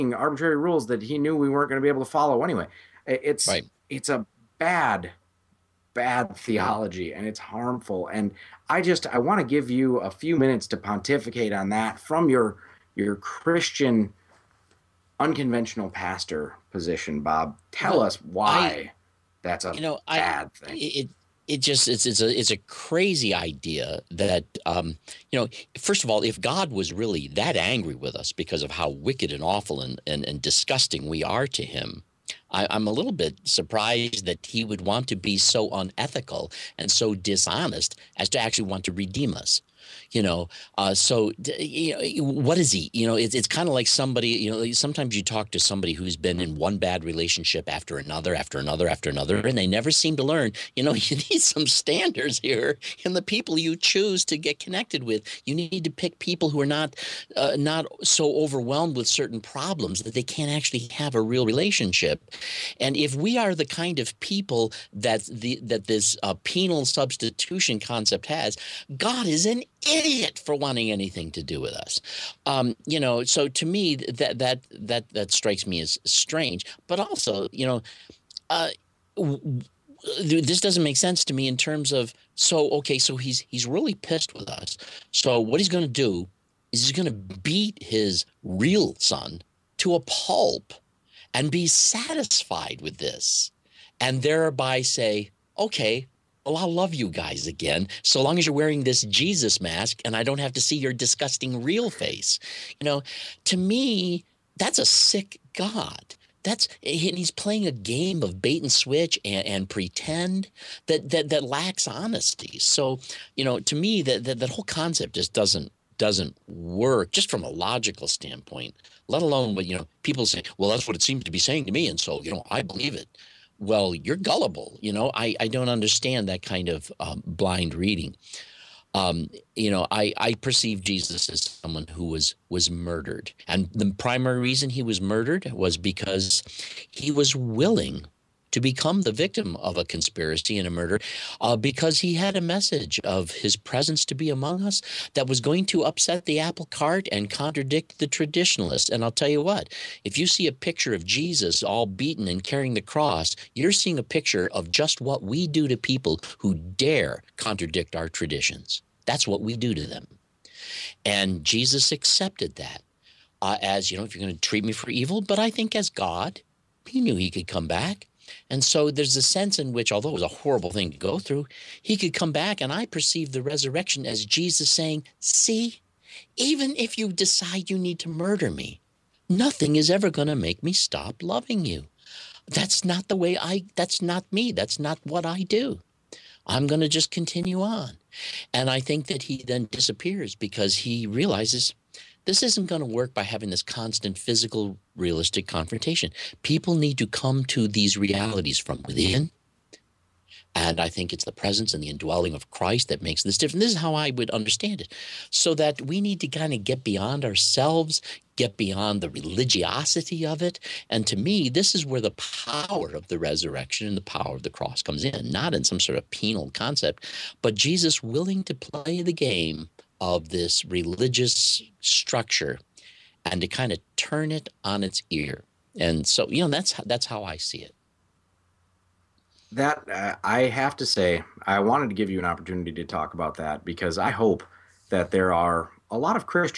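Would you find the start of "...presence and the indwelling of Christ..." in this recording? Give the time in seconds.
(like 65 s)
201 s.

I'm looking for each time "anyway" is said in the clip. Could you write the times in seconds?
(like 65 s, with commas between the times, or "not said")
2 s.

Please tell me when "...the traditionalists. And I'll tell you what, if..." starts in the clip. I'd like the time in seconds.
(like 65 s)
147 s.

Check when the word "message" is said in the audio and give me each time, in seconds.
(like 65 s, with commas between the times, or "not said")
142 s.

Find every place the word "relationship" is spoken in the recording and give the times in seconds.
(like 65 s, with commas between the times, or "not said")
47 s, 61 s.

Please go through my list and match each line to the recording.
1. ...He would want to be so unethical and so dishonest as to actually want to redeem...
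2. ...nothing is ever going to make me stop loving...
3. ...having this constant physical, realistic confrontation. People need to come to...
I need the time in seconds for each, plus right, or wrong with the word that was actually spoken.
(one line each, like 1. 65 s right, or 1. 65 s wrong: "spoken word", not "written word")
1. 34 s right
2. 179 s right
3. 193 s right.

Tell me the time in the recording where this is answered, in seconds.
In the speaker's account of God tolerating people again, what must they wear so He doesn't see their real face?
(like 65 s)
99 s.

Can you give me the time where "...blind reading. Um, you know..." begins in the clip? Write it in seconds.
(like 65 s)
127 s.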